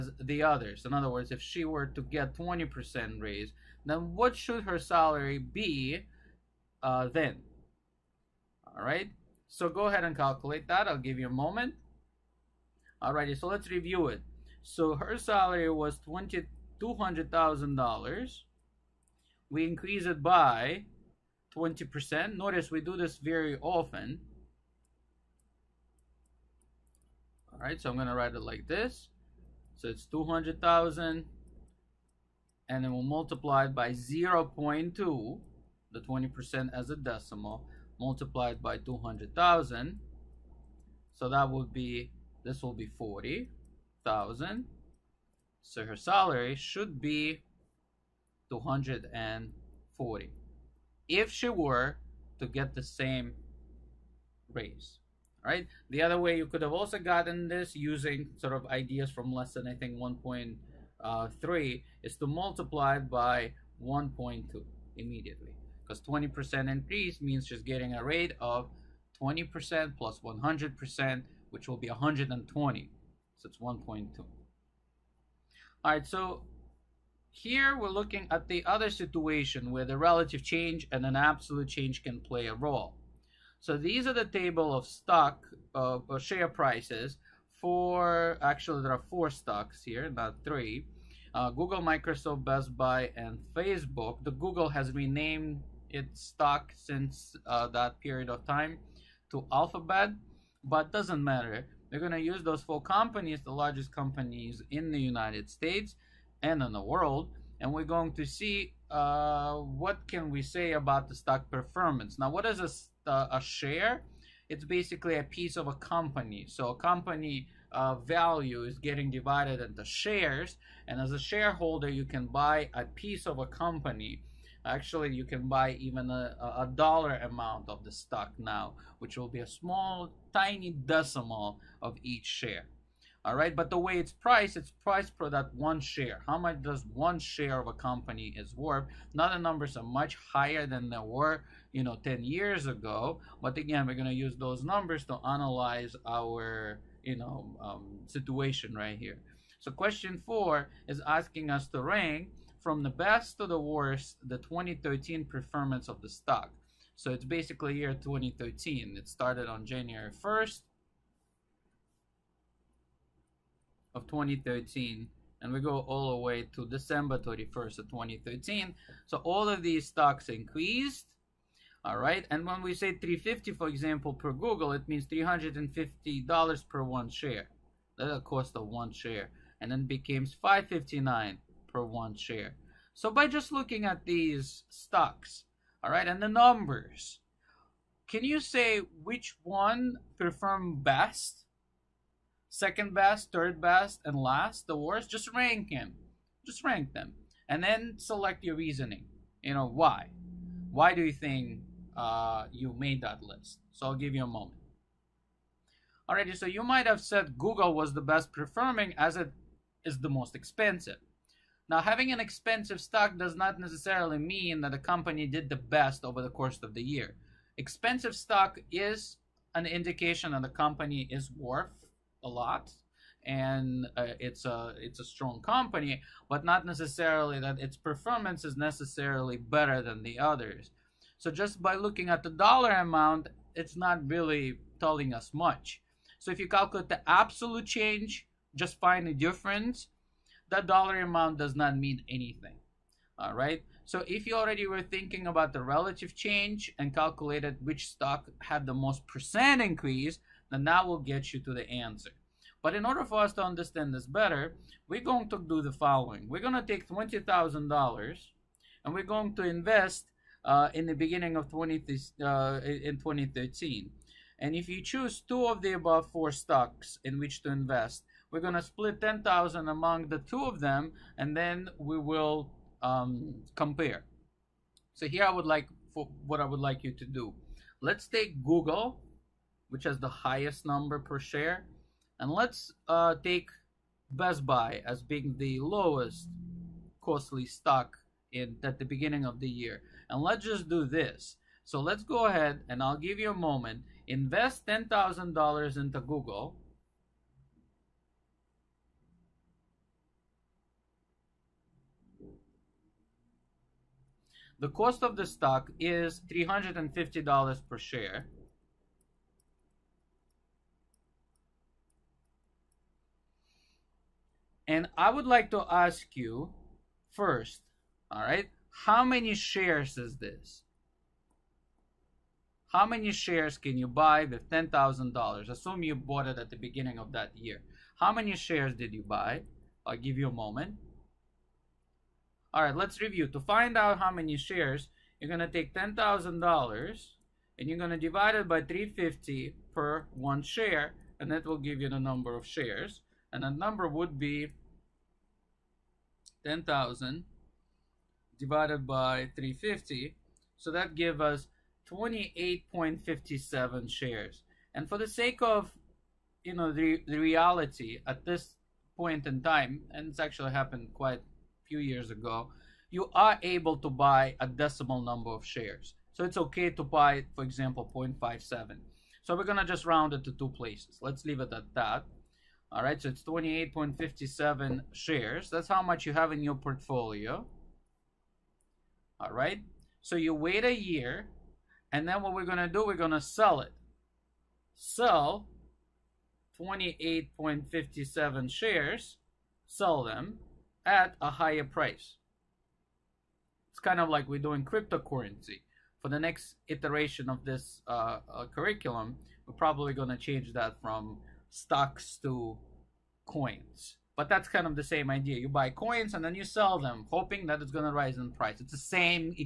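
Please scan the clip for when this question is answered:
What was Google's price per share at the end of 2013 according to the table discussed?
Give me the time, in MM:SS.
03:00.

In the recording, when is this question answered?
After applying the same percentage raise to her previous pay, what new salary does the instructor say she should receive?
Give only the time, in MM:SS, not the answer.
00:48.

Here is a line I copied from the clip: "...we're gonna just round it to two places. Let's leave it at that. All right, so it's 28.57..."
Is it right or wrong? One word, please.
right.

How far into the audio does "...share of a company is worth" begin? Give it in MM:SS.
02:17.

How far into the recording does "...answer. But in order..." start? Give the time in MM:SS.
04:11.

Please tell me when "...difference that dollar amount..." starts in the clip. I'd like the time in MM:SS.
03:59.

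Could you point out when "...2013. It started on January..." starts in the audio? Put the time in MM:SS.
02:37.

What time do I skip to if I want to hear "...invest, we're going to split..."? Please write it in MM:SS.
04:27.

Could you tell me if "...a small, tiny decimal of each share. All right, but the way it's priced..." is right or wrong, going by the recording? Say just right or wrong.
right.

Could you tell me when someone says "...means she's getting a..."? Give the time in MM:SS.
01:07.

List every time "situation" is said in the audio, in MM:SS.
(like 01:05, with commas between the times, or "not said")
01:18, 02:28.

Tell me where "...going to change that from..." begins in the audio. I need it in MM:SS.
06:39.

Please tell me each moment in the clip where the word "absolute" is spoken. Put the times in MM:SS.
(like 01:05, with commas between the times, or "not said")
01:21, 03:57.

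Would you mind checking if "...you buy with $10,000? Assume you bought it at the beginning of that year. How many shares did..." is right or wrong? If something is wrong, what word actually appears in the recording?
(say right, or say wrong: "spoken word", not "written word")
right.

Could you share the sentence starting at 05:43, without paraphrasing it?
And that number would be 10,000 divided by 350.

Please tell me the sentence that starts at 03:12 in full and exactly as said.
Second best, third best, and last, the worst?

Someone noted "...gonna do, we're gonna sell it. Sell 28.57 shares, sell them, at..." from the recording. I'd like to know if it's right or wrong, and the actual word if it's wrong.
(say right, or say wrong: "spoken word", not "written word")
right.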